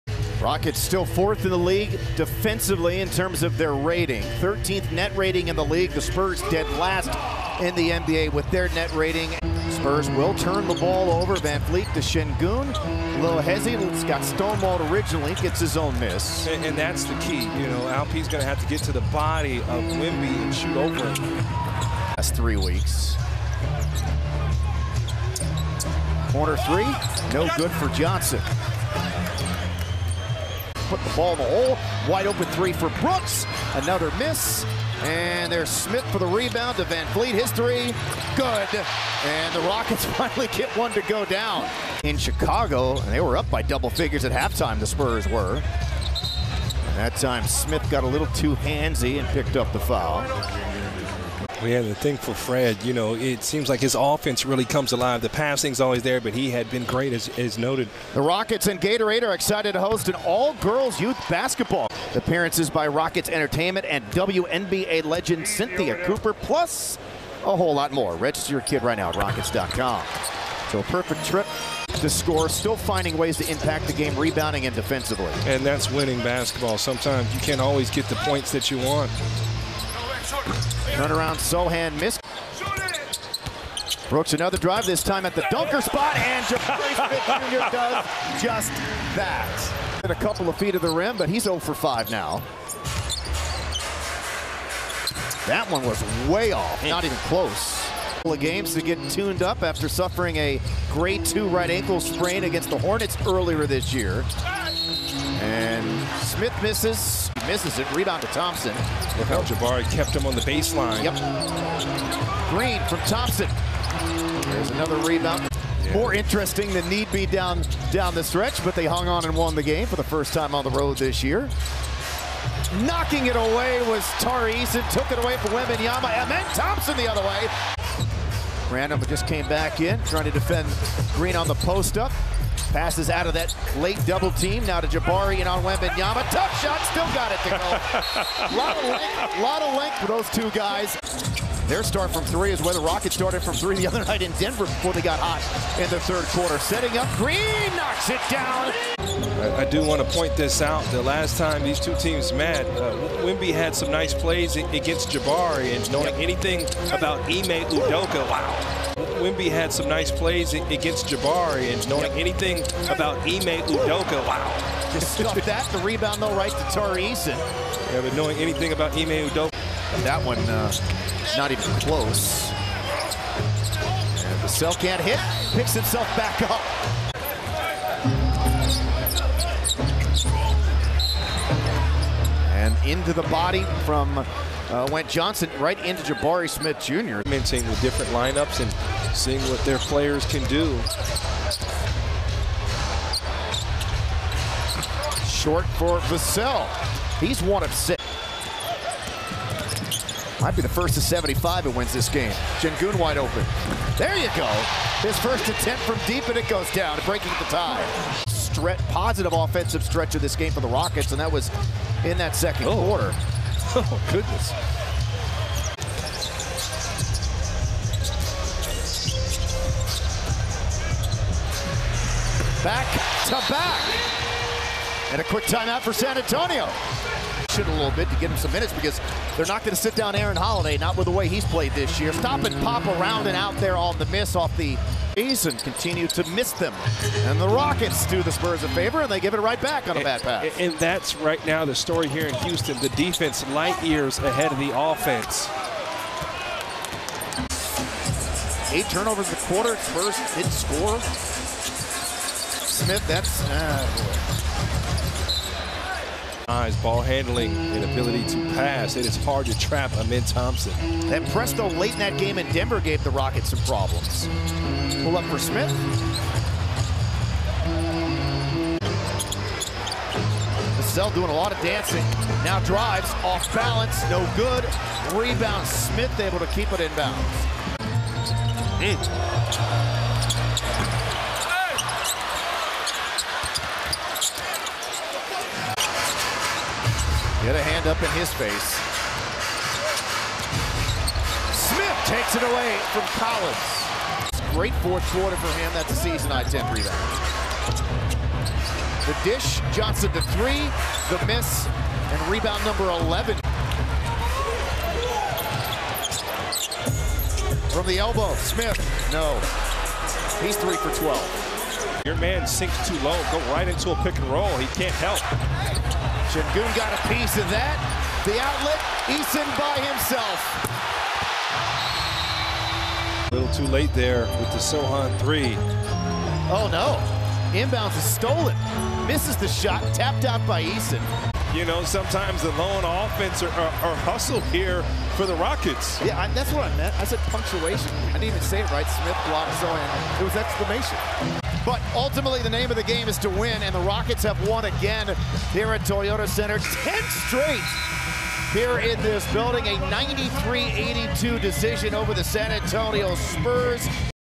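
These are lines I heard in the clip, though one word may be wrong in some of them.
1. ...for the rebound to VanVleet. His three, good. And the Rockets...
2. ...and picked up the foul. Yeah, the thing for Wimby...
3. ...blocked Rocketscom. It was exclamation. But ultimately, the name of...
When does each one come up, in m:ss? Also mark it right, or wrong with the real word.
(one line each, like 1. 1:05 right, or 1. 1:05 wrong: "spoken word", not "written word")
1. 0:36 right
2. 0:49 wrong: "Fred", not "Wimby"
3. 5:39 wrong: "Sochan", not "Rocketscom".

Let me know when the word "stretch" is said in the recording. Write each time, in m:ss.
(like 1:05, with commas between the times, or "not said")
1:58, 3:29.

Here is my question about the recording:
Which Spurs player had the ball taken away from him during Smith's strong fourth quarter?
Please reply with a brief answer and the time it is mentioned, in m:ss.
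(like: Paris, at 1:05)
Collins, at 4:53.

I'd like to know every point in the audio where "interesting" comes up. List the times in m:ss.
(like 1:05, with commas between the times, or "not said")
1:56.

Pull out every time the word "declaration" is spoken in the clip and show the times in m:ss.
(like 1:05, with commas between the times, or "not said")
not said.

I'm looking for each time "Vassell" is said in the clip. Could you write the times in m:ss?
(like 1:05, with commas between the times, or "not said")
2:54, 3:16.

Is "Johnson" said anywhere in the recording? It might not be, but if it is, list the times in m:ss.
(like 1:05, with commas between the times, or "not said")
0:27, 3:05, 4:59.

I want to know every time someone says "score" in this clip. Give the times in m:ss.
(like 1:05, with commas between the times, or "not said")
1:12, 4:10.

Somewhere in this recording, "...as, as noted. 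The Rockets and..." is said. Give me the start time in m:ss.
0:57.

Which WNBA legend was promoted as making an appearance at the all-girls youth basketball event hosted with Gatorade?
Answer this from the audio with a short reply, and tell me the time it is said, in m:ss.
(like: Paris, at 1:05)
Cynthia Cooper, at 1:05.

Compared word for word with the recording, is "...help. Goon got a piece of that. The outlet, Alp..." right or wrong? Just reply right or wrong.
wrong.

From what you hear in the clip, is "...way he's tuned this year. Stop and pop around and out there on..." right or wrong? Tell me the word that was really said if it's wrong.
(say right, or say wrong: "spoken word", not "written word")
wrong: "played", not "tuned".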